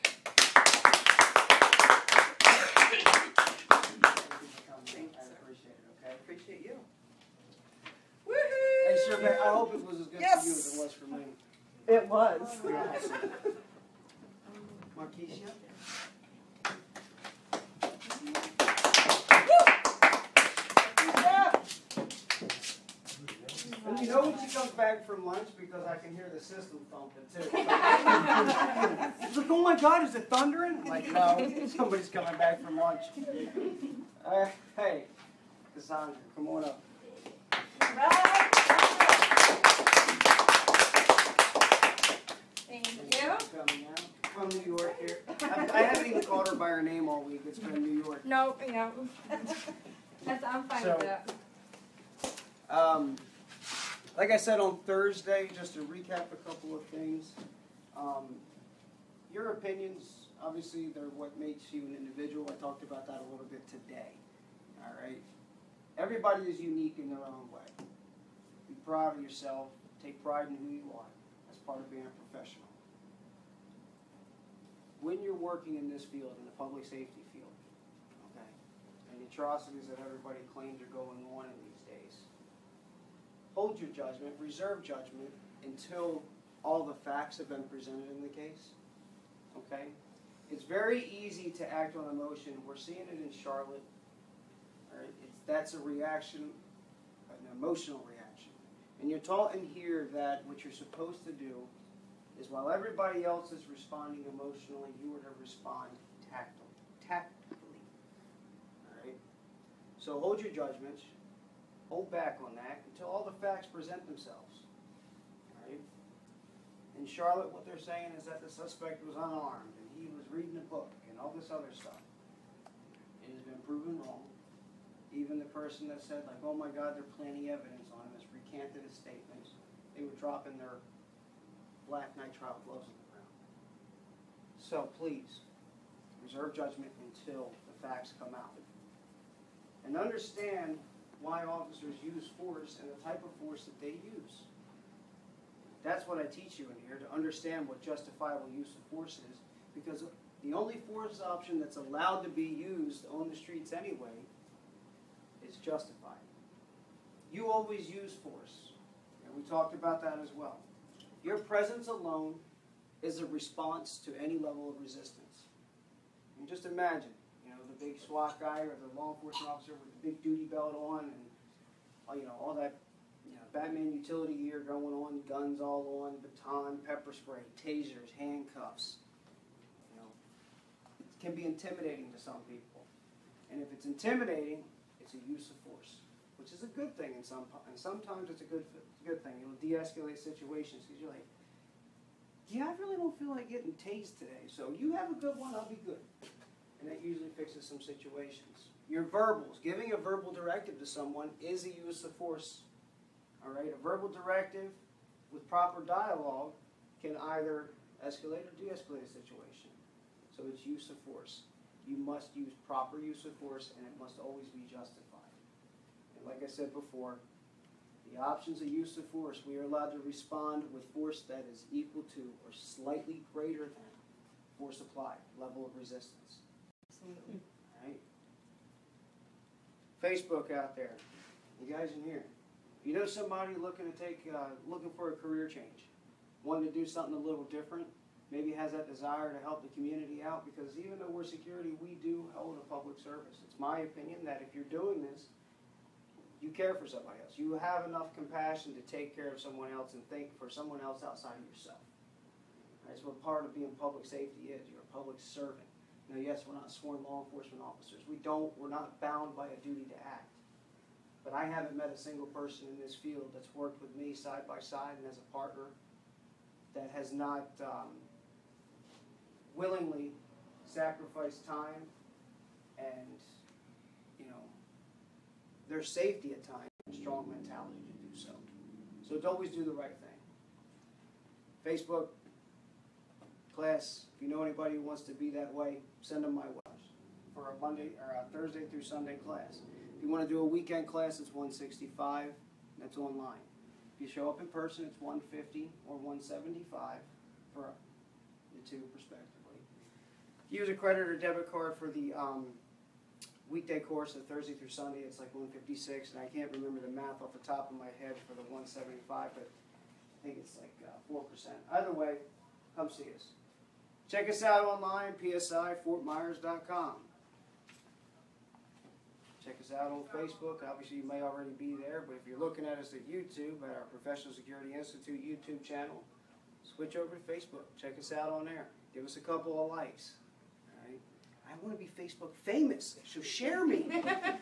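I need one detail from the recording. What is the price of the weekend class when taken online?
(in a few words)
$165.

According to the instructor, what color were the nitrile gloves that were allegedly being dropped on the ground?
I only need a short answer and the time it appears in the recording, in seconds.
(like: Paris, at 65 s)
Black, at 131 s.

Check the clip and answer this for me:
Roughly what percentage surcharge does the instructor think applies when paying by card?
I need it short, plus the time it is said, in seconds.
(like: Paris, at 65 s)
4%, at 311 s.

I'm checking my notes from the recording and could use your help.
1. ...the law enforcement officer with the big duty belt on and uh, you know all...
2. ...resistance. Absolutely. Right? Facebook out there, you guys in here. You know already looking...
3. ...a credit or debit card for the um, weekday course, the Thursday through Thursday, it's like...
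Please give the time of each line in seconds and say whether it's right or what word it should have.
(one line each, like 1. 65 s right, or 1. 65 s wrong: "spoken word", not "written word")
1. 168 s right
2. 225 s wrong: "somebody", not "already"
3. 300 s wrong: "Sunday", not "Thursday".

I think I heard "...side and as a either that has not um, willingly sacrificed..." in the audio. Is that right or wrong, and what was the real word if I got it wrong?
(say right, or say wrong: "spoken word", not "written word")
wrong: "partner", not "either".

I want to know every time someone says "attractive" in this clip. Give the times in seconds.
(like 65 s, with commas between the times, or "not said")
not said.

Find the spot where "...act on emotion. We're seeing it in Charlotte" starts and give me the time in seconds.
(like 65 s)
91 s.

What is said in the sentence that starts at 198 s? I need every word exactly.
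Your verbals, giving a verbal directive to someone is a use of force.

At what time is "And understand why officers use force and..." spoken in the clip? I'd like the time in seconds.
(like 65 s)
139 s.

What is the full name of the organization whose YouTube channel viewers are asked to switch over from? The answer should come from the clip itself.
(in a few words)
Professional Security Institute.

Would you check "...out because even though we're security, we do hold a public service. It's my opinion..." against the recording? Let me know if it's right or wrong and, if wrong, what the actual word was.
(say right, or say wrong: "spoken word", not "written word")
right.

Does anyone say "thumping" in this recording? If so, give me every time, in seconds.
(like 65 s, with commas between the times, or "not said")
26 s.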